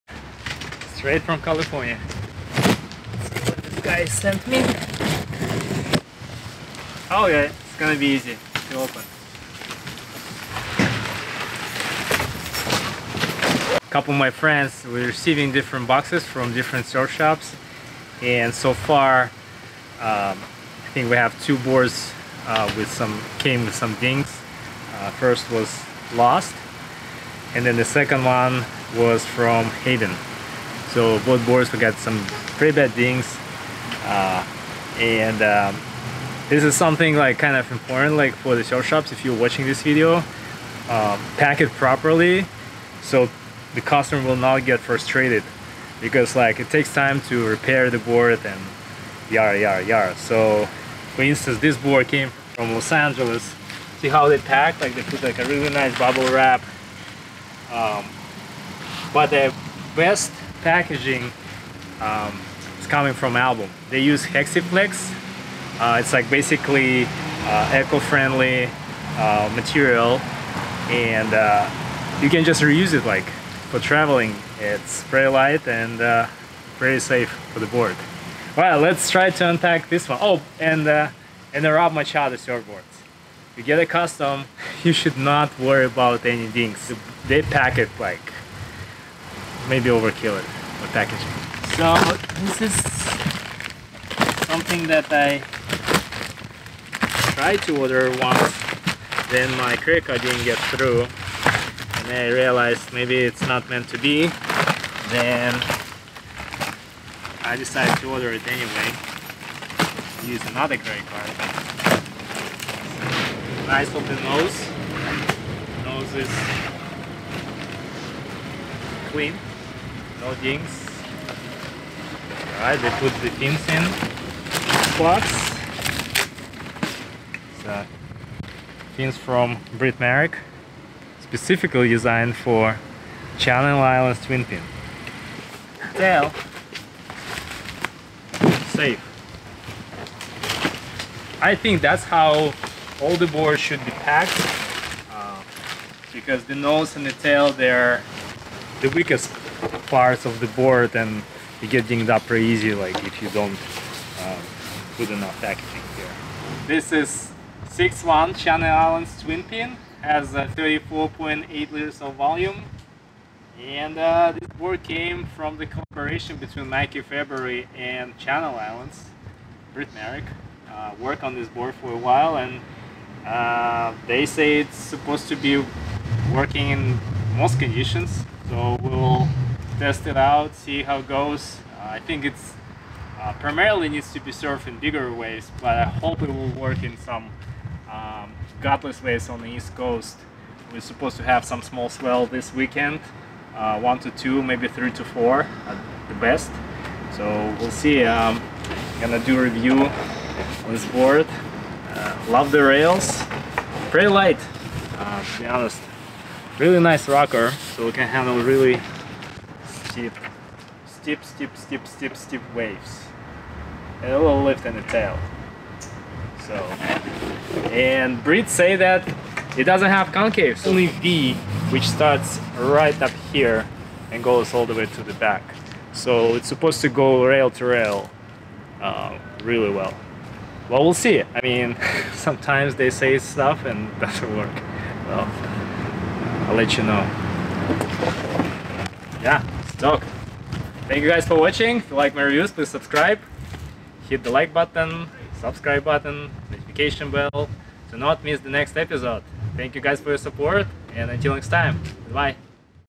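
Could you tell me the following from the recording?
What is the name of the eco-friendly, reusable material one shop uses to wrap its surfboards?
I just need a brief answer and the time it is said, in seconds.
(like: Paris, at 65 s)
Hexiflex, at 64 s.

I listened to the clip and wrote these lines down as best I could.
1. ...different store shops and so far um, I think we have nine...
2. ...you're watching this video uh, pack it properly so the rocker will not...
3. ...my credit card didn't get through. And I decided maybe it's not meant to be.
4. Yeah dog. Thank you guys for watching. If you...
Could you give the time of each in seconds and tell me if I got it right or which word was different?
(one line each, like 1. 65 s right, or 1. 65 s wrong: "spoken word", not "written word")
1. 16 s wrong: "two", not "nine"
2. 39 s wrong: "customer", not "rocker"
3. 99 s wrong: "realized", not "decided"
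4. 239 s right.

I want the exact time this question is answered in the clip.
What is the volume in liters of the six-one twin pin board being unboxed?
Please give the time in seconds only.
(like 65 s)
160 s.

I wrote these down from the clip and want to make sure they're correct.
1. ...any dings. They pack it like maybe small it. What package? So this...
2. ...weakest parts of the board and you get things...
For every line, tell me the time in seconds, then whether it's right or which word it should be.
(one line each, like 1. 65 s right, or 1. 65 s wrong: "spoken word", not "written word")
1. 86 s wrong: "overkill", not "small"
2. 148 s right.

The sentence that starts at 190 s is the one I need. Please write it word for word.
We're supposed to have some small swell this weekend, uh, one to two, maybe three to four at the best.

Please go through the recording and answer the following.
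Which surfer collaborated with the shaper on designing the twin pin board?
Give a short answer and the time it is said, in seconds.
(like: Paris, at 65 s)
Mikey February, at 166 s.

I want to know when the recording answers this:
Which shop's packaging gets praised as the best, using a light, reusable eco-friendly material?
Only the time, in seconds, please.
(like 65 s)
63 s.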